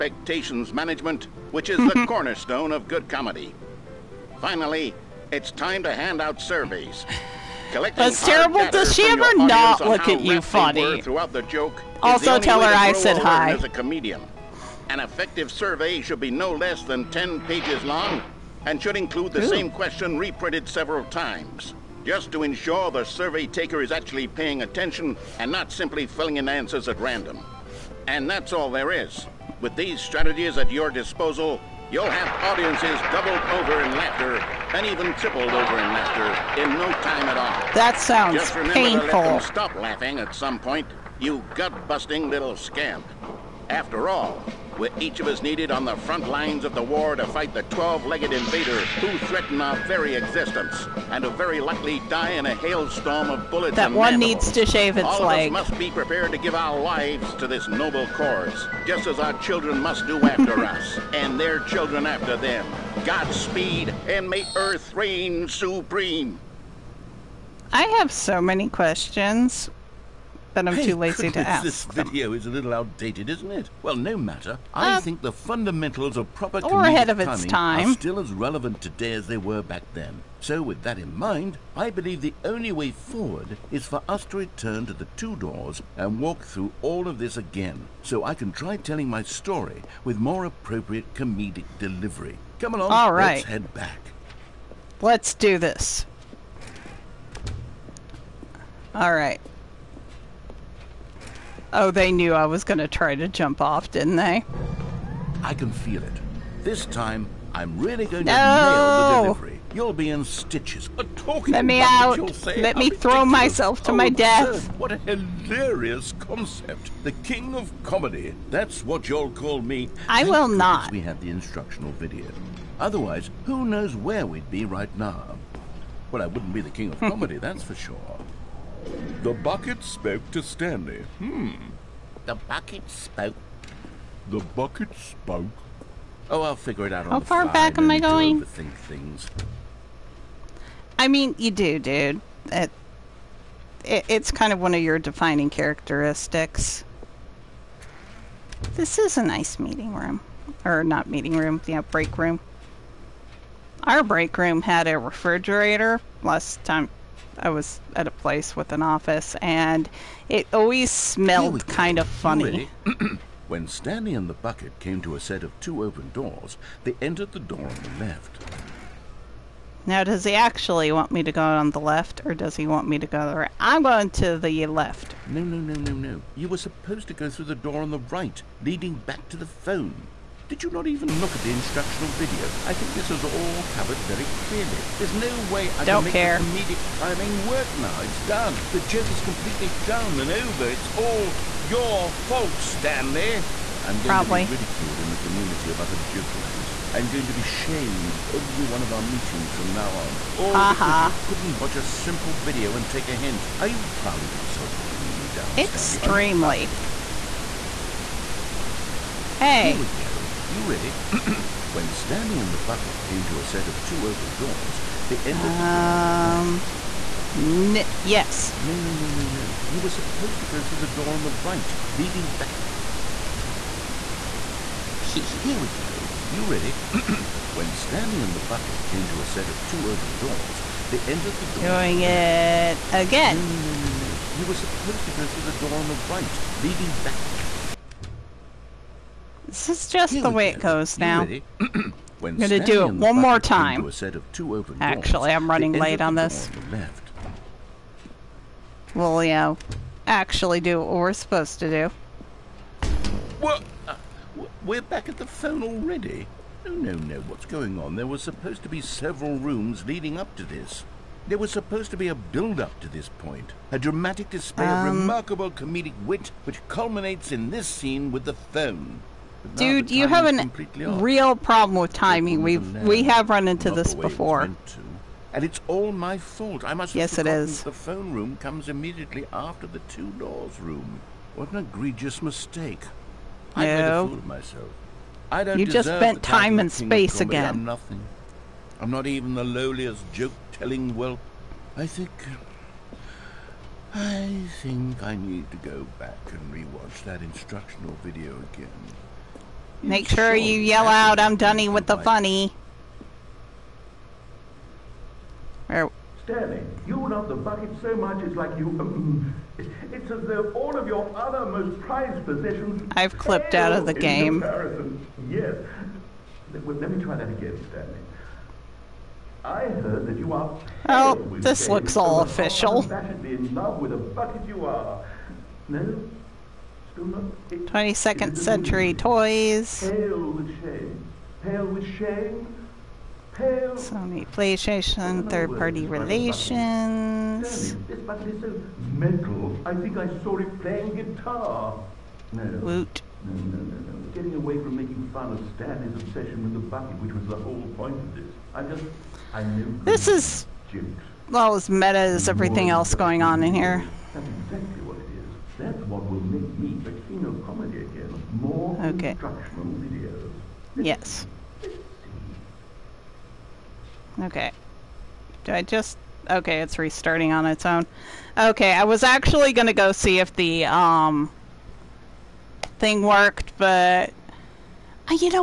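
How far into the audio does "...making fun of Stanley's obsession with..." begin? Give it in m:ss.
5:44.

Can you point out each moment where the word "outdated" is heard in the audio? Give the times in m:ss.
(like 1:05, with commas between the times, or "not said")
1:12.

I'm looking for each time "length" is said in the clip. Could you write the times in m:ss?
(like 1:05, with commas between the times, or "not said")
not said.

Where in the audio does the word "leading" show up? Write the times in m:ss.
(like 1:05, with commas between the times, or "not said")
2:58, 3:41, 3:56, 4:19.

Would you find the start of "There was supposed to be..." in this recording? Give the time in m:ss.
4:21.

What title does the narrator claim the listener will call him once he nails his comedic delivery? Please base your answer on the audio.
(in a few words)
The king of comedy.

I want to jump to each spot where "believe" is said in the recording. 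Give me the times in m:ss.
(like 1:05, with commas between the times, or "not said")
1:21.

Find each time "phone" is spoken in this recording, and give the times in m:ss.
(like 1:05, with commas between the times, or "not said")
2:59, 4:15, 4:28, 4:37.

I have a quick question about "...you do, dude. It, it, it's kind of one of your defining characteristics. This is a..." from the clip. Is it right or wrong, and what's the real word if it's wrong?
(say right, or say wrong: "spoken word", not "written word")
right.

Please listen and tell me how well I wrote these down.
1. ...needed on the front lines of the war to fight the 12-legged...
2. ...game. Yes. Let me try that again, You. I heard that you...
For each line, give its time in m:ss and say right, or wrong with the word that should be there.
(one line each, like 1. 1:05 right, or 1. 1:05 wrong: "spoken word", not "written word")
1. 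0:45 right
2. 5:13 wrong: "Stanley", not "You".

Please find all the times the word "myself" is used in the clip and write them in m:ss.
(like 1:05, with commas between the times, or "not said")
1:53, 4:44.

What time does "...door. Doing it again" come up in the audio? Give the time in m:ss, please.
3:51.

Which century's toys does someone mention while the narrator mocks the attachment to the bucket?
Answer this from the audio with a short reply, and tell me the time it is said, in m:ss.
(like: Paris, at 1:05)
22nd century, at 5:26.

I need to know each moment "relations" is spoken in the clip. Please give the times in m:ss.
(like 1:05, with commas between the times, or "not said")
5:35.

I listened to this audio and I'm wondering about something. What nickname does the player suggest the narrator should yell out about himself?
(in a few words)
Dunny with the funny.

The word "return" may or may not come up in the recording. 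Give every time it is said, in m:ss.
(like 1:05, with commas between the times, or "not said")
1:24.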